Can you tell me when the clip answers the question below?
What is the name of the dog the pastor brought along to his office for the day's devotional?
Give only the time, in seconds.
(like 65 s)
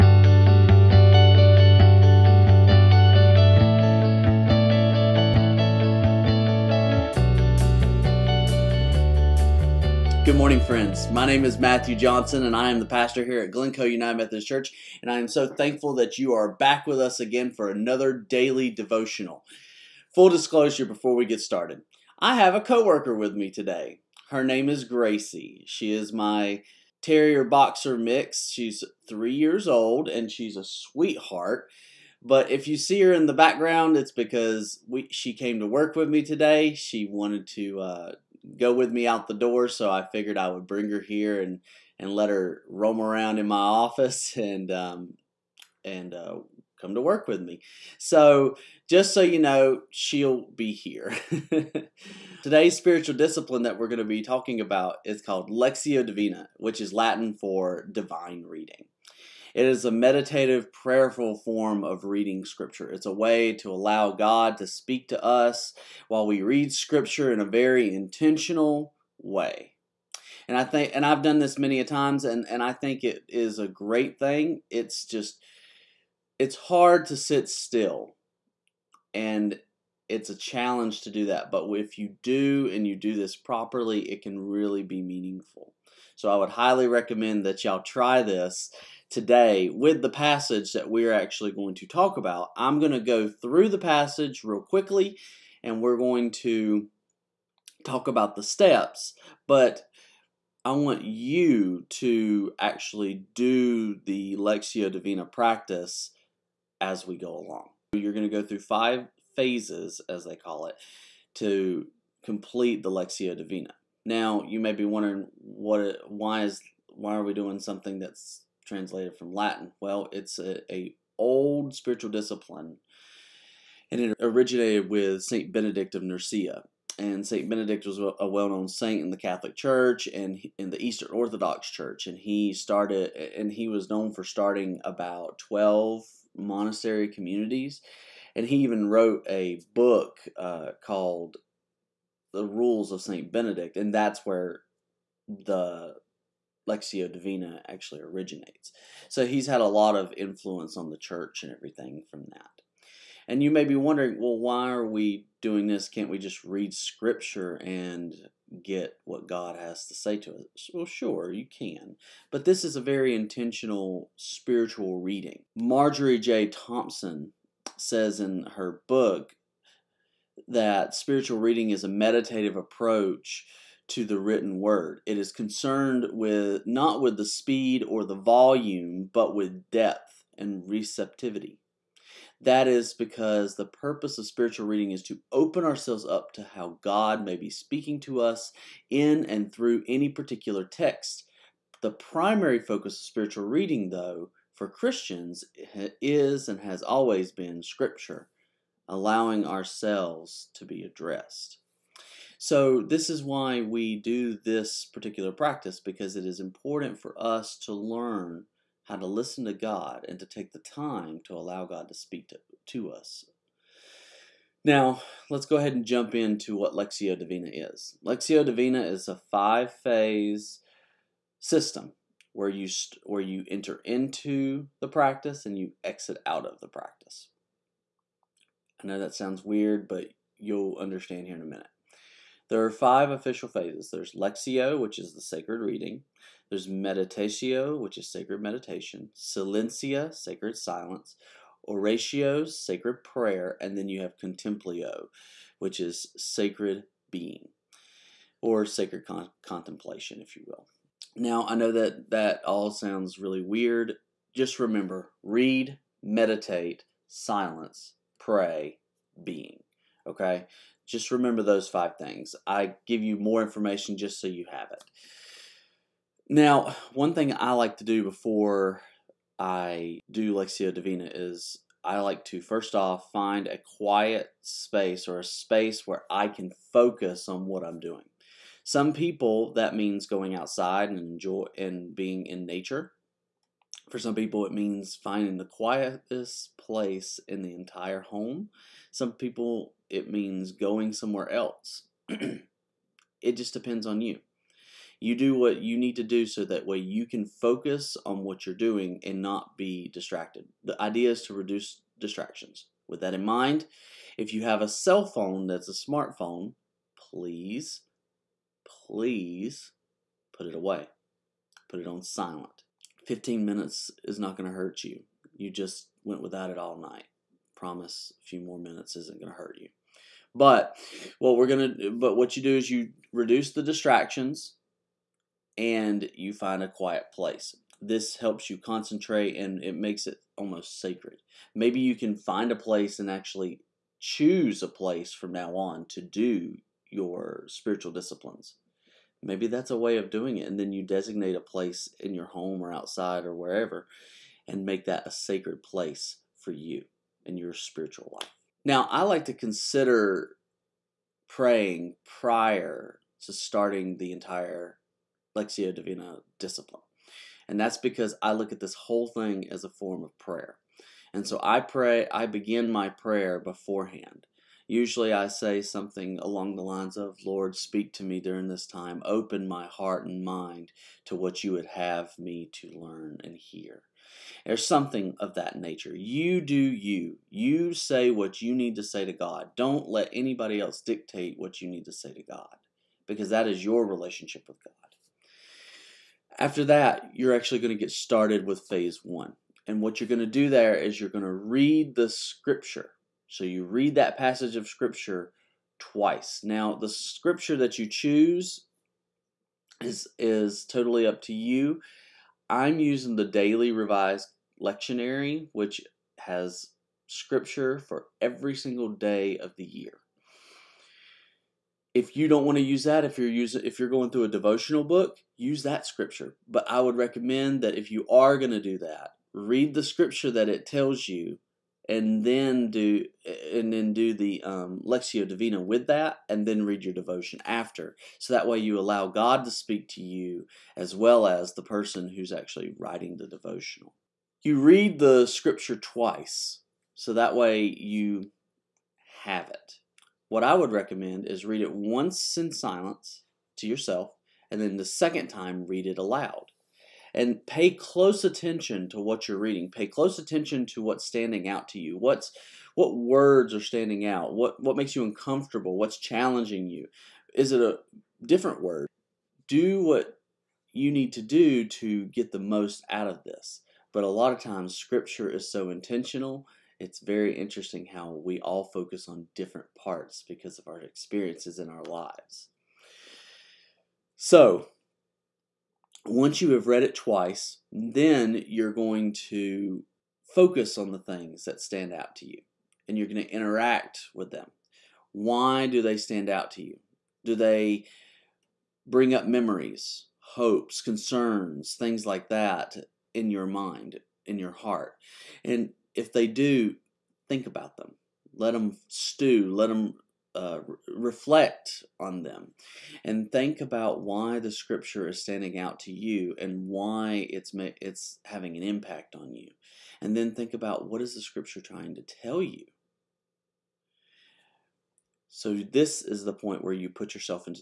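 24 s.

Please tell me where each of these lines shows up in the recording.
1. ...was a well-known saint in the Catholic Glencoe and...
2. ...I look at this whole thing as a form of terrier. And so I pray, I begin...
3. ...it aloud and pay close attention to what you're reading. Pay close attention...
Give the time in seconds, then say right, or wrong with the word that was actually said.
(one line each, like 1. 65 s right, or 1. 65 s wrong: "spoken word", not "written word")
1. 127 s wrong: "Church", not "Glencoe"
2. 358 s wrong: "prayer", not "terrier"
3. 445 s right.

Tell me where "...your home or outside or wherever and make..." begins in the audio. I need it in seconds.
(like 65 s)
342 s.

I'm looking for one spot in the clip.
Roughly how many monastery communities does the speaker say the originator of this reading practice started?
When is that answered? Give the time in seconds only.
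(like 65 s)
135 s.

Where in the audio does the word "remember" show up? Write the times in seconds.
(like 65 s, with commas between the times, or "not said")
254 s, 261 s.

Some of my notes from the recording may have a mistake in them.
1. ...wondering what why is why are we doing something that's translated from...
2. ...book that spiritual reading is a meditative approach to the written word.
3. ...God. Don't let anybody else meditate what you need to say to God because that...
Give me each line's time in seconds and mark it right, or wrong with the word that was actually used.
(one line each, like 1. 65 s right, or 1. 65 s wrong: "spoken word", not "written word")
1. 114 s right
2. 168 s right
3. 379 s wrong: "dictate", not "meditate".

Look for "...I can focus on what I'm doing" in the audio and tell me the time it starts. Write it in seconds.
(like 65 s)
276 s.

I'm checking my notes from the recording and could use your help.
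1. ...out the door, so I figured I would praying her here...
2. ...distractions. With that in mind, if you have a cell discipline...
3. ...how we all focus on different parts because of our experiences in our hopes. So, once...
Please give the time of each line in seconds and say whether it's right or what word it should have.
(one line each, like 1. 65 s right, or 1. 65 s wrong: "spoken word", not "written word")
1. 39 s wrong: "bring", not "praying"
2. 301 s wrong: "phone", not "discipline"
3. 467 s wrong: "lives", not "hopes".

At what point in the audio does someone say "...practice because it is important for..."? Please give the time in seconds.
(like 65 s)
205 s.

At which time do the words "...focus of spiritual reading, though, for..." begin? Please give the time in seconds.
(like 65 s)
192 s.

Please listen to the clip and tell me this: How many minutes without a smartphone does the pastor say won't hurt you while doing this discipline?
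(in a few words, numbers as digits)
15.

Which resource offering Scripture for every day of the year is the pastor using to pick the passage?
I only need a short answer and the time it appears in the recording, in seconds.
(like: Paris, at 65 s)
Daily Revised Lectionary, at 403 s.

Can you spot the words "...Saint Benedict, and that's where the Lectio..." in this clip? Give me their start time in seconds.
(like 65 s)
143 s.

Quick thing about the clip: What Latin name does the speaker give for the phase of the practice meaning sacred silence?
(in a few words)
Silencia.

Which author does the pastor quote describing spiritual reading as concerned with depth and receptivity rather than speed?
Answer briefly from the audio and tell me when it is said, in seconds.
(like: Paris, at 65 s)
Marjorie J. Thompson, at 165 s.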